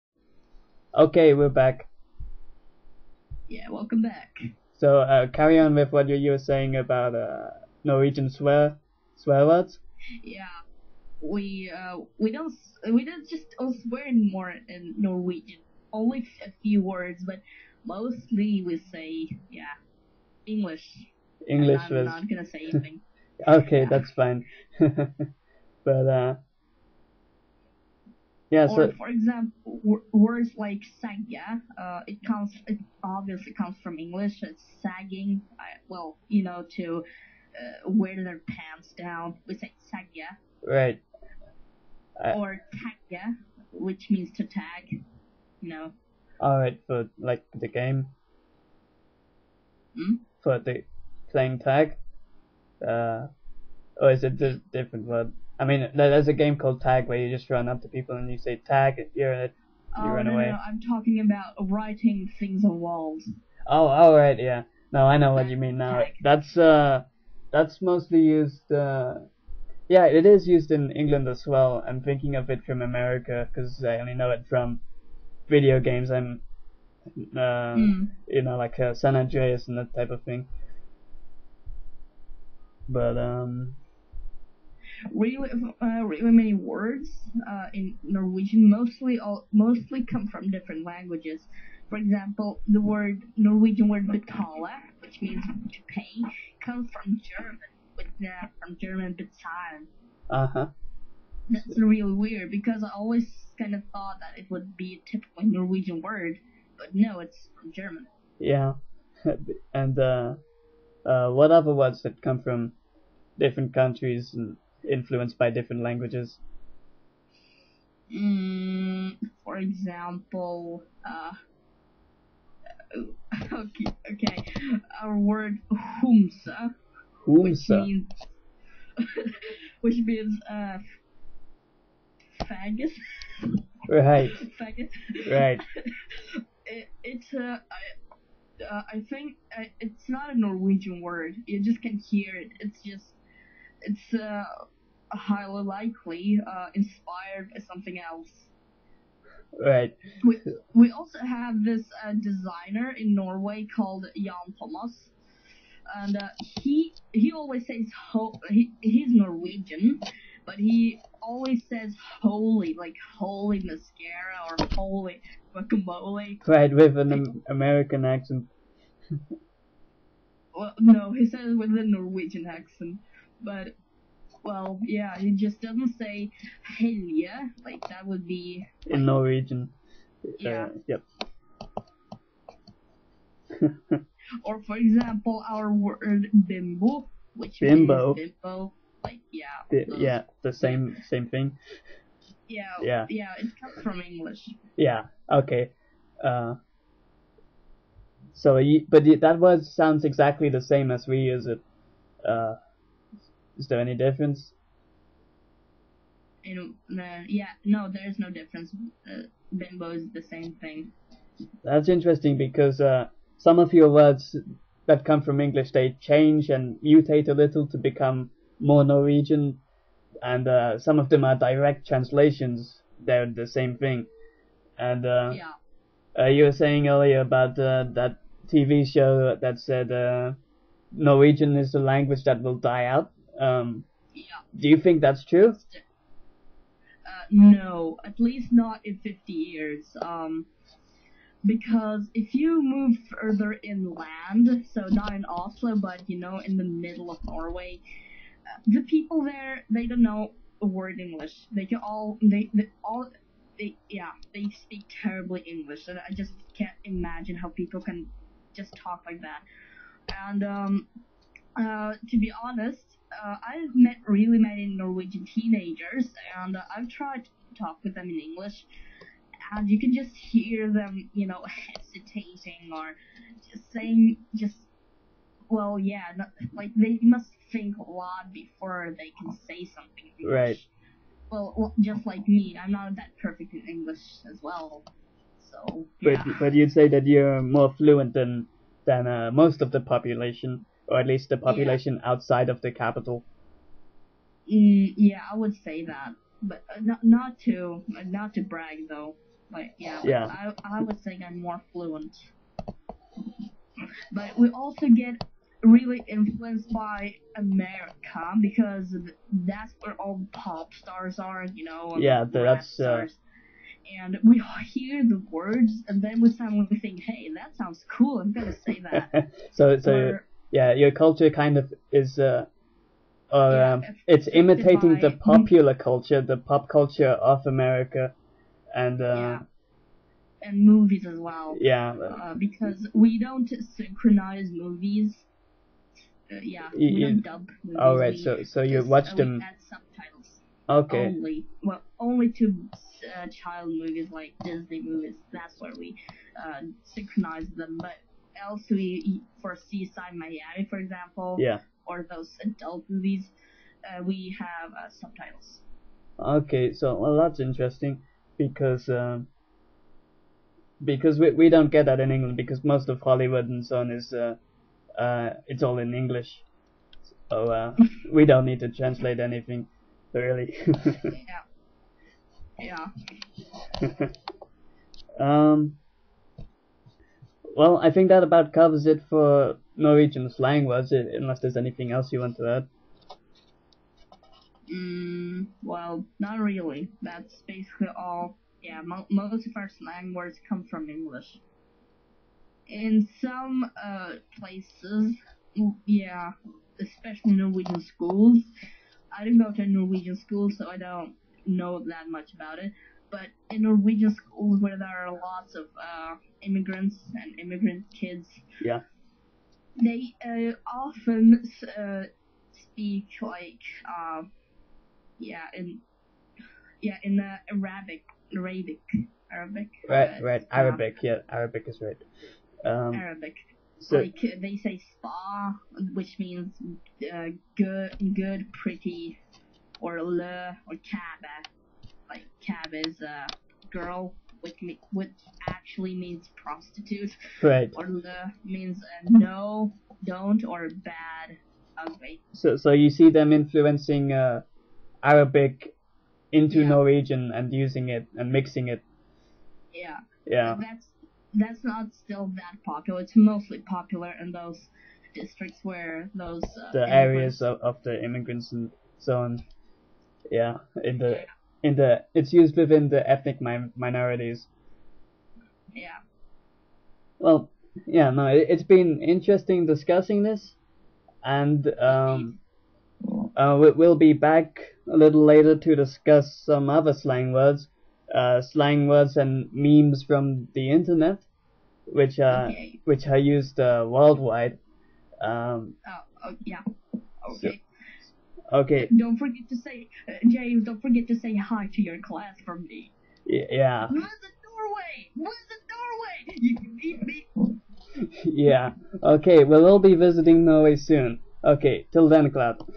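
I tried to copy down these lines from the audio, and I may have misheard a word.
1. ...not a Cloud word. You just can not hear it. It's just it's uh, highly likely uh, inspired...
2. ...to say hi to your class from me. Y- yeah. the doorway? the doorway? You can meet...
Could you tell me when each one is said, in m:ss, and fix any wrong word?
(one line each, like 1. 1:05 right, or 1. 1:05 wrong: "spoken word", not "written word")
1. 2:20 wrong: "Norwegian", not "Cloud"
2. 8:11 right.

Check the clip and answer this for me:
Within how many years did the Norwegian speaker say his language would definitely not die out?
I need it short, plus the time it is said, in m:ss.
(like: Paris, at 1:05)
50, at 3:58.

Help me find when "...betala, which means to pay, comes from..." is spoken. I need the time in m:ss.
1:34.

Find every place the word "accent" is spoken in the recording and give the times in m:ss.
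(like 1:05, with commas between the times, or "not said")
2:48, 2:52.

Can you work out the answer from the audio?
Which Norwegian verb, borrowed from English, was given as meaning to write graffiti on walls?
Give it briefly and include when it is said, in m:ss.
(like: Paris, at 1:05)
tagia, at 0:42.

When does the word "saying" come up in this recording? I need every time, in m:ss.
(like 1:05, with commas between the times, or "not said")
0:06, 3:46, 4:33.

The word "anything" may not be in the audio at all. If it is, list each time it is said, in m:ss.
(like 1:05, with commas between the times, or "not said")
0:22, 6:09, 6:21.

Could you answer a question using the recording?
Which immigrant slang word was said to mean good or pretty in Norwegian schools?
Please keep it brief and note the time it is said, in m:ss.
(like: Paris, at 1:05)
spa, at 7:04.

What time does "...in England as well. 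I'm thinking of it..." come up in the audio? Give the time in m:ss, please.
1:10.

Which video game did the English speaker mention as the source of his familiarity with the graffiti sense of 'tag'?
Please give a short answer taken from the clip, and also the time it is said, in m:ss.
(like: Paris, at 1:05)
San Andreas, at 1:18.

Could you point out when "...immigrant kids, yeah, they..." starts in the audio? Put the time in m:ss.
6:47.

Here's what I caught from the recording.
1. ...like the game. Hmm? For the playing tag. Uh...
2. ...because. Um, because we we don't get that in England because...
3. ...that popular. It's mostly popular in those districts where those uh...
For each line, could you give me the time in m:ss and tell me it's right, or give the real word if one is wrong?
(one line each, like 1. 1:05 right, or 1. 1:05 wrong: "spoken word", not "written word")
1. 0:47 right
2. 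5:58 right
3. 7:32 right.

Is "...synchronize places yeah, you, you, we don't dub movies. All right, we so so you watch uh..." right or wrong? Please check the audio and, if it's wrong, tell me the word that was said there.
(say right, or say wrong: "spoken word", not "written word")
wrong: "movies", not "places".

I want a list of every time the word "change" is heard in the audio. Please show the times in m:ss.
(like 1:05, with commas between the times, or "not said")
3:35.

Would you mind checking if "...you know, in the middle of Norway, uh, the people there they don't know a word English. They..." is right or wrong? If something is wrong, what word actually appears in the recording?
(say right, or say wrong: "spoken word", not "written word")
right.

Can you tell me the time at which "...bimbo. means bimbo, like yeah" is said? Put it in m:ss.
3:07.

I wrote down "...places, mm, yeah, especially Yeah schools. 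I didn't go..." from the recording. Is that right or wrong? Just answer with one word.
wrong.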